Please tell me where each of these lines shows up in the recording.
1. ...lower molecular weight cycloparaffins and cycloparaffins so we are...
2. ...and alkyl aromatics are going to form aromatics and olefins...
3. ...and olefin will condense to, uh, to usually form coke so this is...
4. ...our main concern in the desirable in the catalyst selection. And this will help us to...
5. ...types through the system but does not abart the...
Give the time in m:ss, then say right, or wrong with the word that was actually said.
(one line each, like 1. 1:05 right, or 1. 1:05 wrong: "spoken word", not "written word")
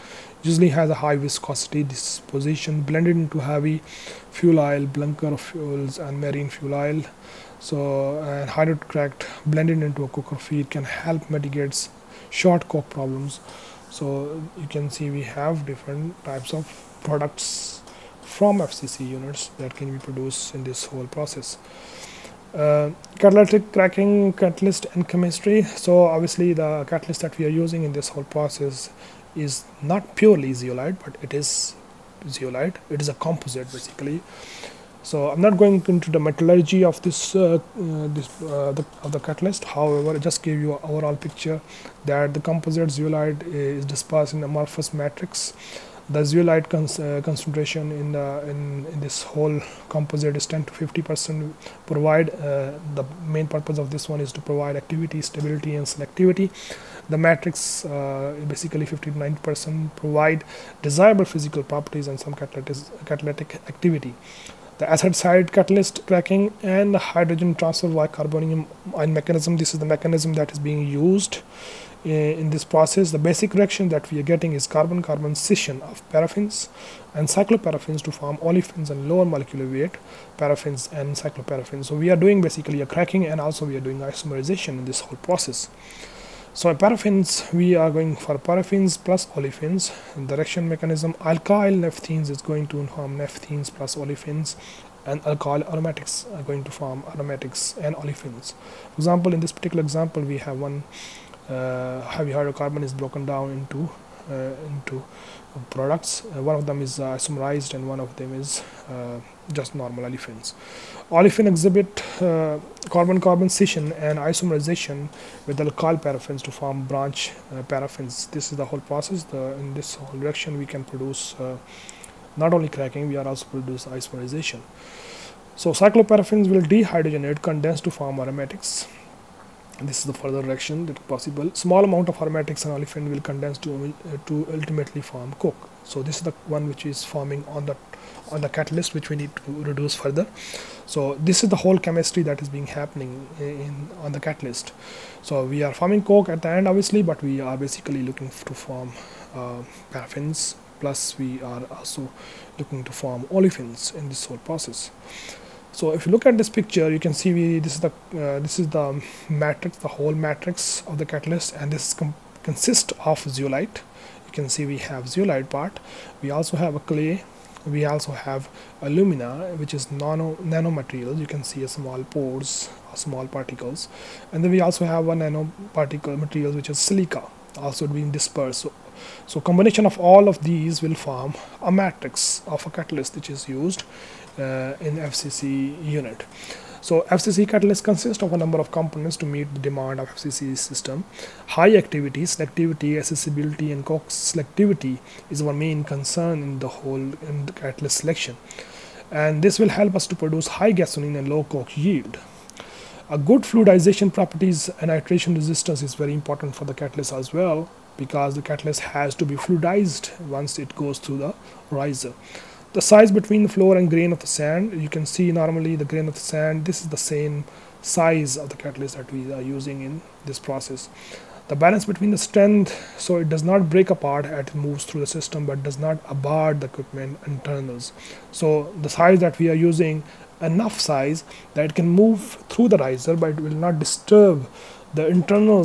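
1. 1:19 wrong: "paraffins", not "cycloparaffins"
2. 1:35 right
3. 2:12 wrong: "ultimately", not "usually"
4. 3:15 wrong: "whole", not "desirable"
5. 3:44 wrong: "moves", not "types".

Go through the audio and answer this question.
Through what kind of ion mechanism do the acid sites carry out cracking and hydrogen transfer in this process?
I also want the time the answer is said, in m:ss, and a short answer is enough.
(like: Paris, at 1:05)
Carbonium ion, at 1:08.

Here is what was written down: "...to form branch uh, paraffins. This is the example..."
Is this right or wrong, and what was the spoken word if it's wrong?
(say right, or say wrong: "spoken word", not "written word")
wrong: "whole", not "example".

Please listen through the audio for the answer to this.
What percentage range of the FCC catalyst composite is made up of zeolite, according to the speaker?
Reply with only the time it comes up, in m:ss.
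0:50.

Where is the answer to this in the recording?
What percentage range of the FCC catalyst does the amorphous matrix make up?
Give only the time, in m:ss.
0:58.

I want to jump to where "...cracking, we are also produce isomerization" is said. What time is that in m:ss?
2:02.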